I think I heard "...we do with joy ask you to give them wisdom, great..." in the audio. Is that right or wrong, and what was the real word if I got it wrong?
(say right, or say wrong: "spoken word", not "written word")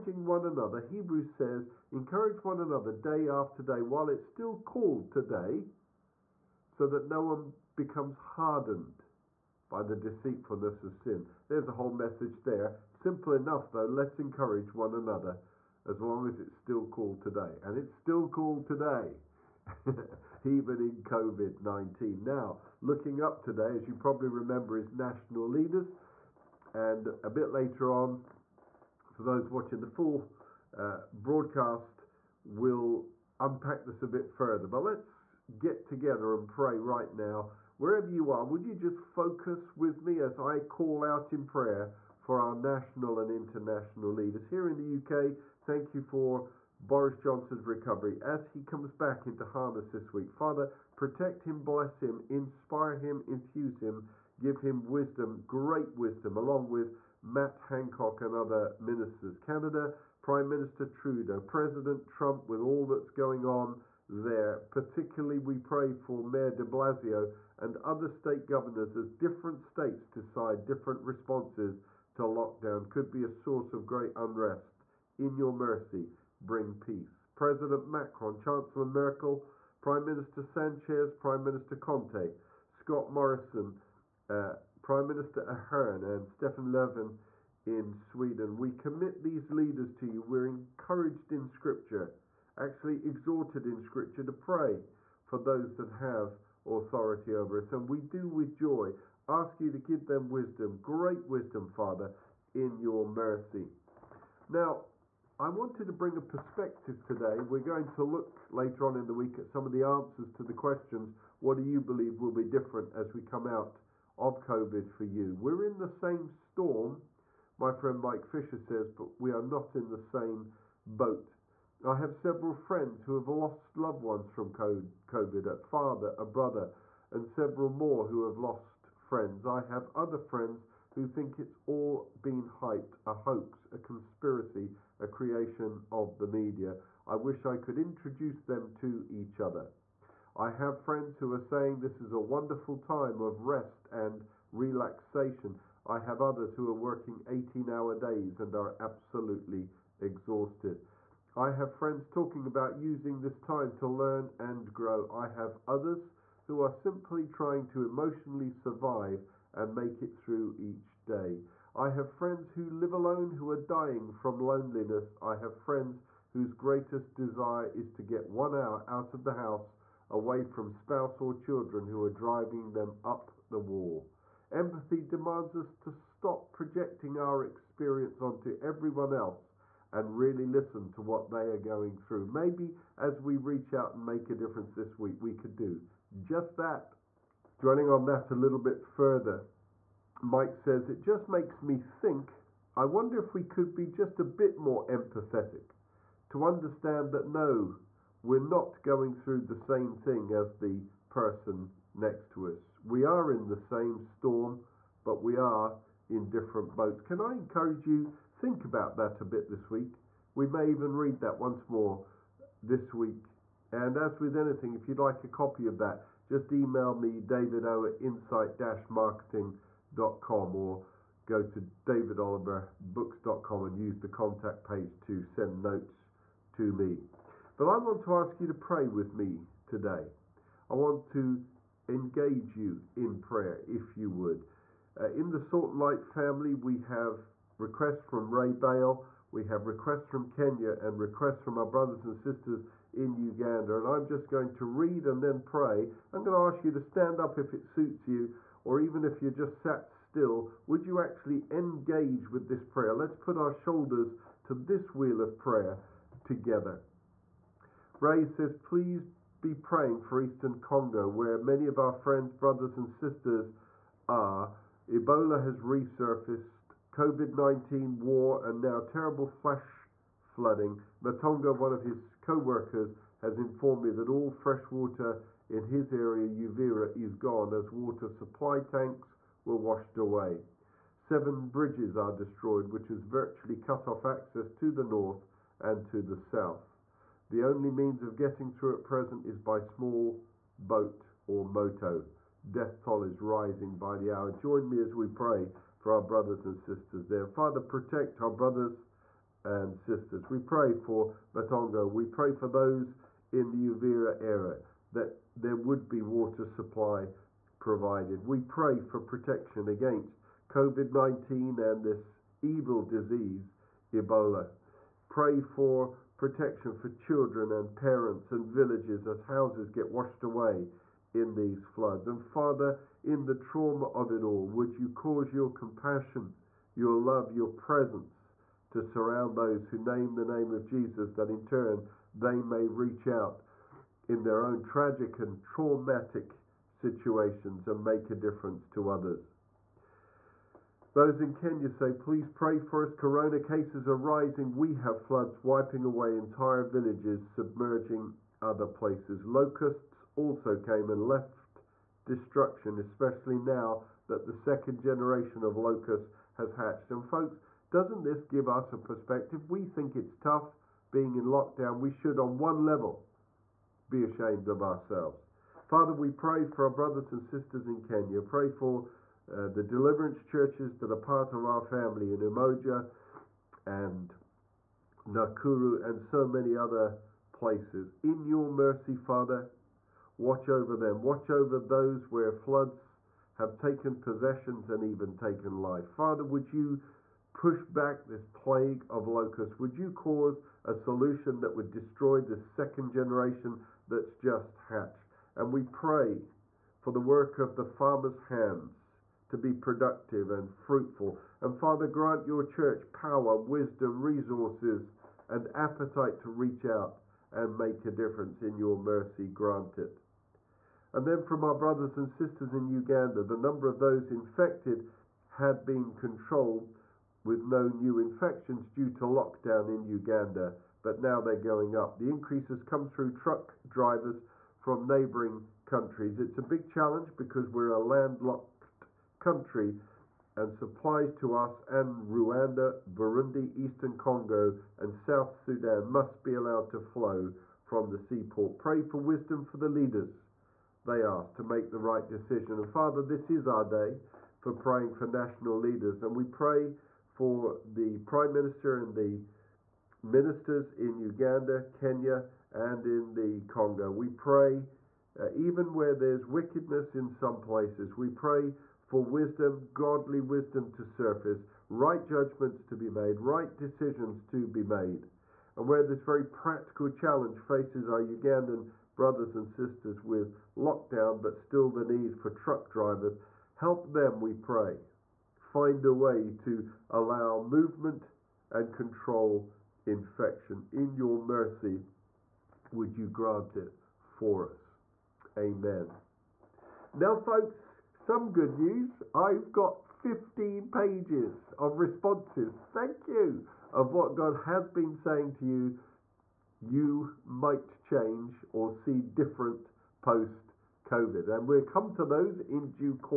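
right.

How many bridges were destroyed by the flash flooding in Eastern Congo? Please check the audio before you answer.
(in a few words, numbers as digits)
7.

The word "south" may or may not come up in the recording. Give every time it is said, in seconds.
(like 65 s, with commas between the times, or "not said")
286 s, 434 s.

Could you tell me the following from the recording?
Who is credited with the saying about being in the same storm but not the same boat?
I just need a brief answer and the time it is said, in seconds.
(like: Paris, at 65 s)
Mike Fisher, at 117 s.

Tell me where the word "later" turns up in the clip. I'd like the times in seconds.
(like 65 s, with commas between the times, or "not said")
27 s, 108 s.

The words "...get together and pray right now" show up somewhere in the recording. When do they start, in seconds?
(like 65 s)
35 s.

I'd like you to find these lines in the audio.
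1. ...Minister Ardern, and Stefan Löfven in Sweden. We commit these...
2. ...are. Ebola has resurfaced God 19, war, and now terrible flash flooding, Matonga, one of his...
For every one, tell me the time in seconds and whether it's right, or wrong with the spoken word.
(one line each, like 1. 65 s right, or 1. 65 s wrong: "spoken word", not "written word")
1. 85 s right
2. 264 s wrong: "COVID", not "God".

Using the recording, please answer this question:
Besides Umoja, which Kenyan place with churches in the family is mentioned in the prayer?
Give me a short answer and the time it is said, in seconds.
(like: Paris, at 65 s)
Nakuru, at 375 s.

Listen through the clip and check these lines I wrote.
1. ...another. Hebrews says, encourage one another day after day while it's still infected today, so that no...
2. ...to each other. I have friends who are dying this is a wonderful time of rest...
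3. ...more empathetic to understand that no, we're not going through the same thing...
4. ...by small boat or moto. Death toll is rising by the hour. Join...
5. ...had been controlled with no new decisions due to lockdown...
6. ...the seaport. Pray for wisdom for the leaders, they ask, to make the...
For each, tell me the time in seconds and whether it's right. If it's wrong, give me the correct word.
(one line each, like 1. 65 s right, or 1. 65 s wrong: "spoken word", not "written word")
1. 0 s wrong: "called", not "infected"
2. 138 s wrong: "saying", not "dying"
3. 194 s right
4. 289 s right
5. 415 s wrong: "infections", not "decisions"
6. 437 s right.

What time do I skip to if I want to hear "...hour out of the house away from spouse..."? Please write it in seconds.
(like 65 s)
168 s.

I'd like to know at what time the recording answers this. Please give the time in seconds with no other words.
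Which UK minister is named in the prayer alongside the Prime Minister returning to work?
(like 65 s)
57 s.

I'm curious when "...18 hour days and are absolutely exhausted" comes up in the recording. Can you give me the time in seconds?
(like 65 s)
147 s.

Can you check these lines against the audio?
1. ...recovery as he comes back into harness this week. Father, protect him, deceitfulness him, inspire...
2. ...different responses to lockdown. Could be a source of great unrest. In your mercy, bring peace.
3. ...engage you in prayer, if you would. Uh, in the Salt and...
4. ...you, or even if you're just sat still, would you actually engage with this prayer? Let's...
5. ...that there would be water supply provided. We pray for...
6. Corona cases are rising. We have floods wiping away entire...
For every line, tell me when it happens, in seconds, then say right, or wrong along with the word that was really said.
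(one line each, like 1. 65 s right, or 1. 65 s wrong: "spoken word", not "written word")
1. 47 s wrong: "bless", not "deceitfulness"
2. 70 s right
3. 231 s right
4. 248 s right
5. 304 s right
6. 342 s right.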